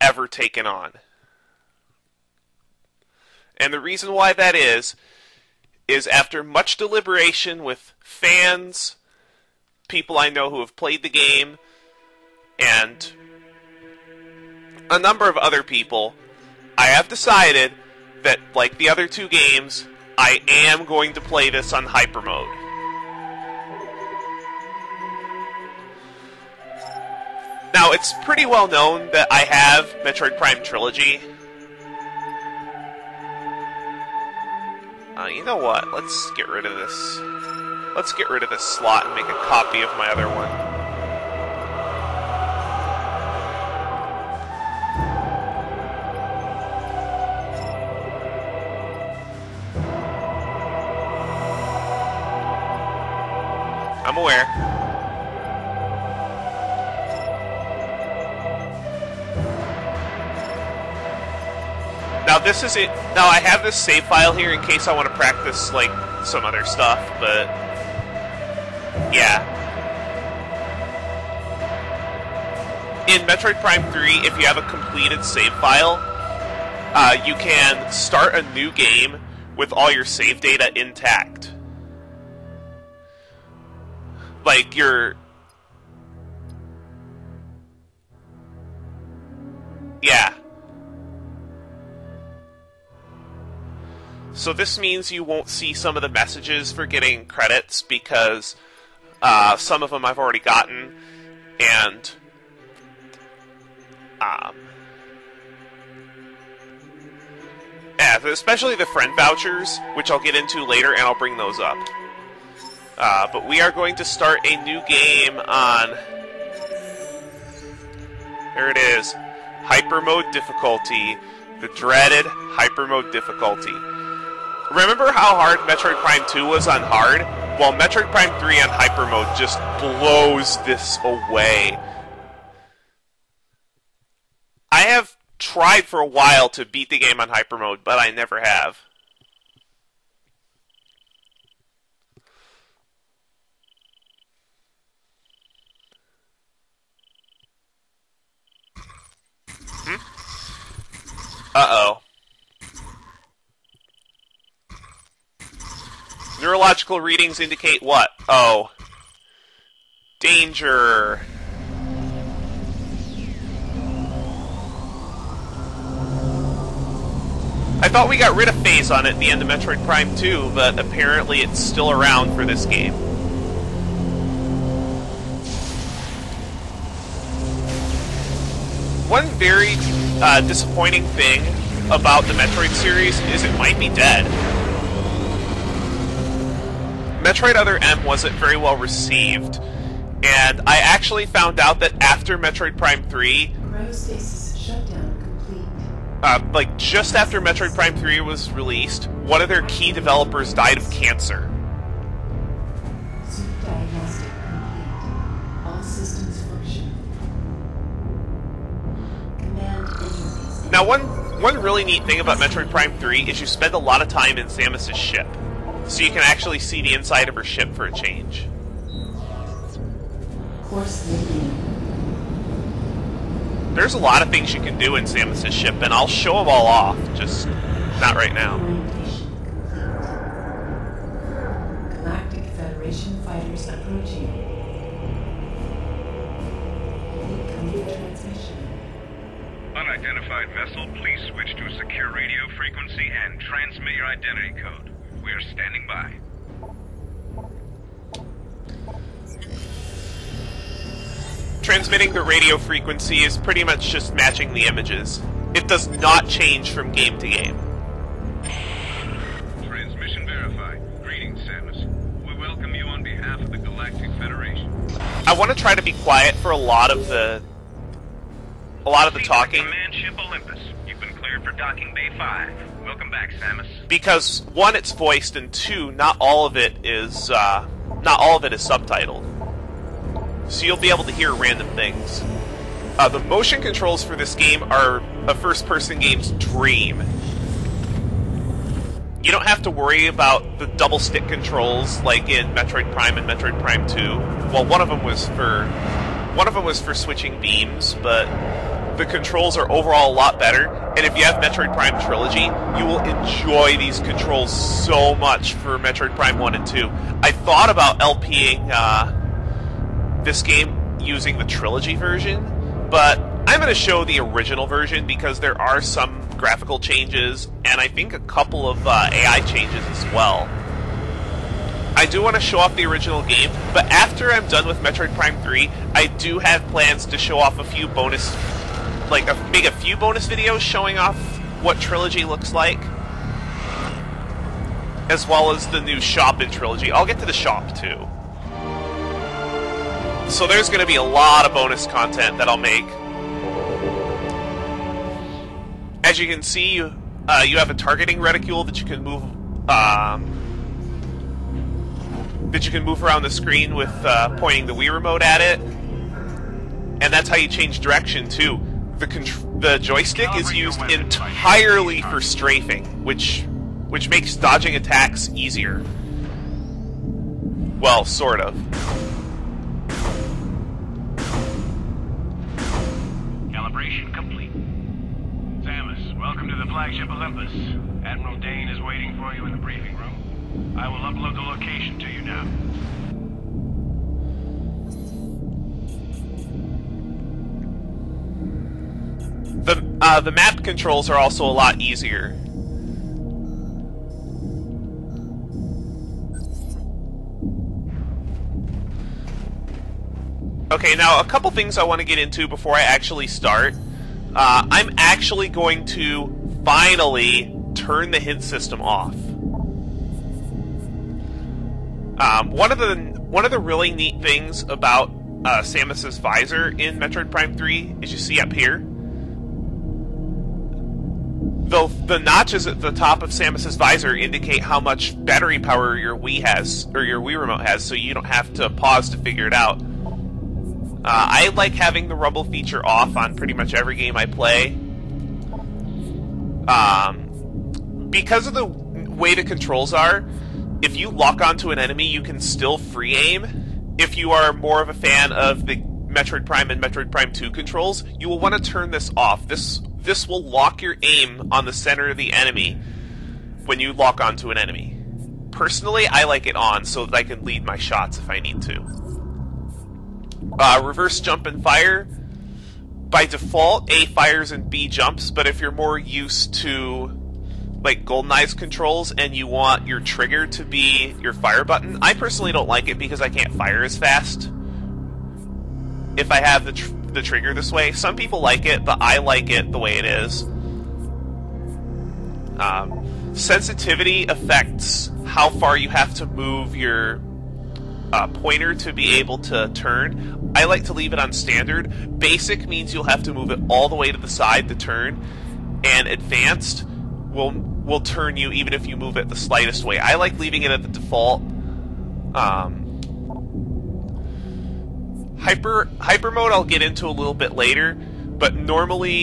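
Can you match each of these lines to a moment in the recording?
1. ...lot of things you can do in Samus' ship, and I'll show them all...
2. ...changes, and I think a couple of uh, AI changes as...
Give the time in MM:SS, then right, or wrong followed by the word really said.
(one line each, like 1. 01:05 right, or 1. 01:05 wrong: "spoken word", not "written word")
1. 03:43 right
2. 05:16 right.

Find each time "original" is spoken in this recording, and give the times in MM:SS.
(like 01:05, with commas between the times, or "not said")
05:14, 05:22.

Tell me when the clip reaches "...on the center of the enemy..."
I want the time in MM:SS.
07:31.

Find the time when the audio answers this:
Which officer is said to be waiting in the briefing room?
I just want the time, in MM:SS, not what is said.
06:18.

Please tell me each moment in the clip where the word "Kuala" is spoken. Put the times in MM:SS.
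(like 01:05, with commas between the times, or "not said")
not said.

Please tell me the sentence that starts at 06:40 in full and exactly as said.
Okay, now a couple things I want to get into before I actually start.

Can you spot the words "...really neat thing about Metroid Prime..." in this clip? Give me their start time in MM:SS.
03:31.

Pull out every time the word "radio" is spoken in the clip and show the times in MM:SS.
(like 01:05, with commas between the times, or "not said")
04:02, 04:12.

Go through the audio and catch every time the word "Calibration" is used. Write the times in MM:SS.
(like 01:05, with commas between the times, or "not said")
06:13.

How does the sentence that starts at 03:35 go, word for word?
So you can actually see the inside of her ship for a change.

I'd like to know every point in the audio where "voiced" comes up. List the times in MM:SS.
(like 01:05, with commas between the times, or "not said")
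04:34.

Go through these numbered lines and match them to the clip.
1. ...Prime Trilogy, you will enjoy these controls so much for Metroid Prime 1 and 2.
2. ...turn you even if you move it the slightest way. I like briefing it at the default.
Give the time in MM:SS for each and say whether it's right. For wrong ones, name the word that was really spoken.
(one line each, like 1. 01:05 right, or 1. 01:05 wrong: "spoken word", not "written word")
1. 05:01 right
2. 08:17 wrong: "leaving", not "briefing".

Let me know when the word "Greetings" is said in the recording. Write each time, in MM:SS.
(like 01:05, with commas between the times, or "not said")
04:21.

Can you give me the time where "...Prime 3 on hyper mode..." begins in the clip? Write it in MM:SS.
02:08.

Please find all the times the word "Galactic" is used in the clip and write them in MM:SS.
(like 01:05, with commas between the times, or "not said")
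03:51, 04:23.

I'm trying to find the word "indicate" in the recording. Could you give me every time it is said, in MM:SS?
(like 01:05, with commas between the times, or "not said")
02:37, 07:04.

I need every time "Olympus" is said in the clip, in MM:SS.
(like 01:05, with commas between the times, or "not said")
04:30, 06:17.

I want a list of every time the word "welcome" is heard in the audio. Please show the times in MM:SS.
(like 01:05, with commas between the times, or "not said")
04:22, 04:32, 06:16.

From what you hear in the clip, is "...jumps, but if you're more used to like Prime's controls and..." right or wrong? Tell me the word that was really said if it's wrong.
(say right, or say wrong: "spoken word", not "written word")
wrong: "GoldenEye", not "Prime".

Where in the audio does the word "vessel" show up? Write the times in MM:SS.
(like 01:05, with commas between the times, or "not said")
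04:00.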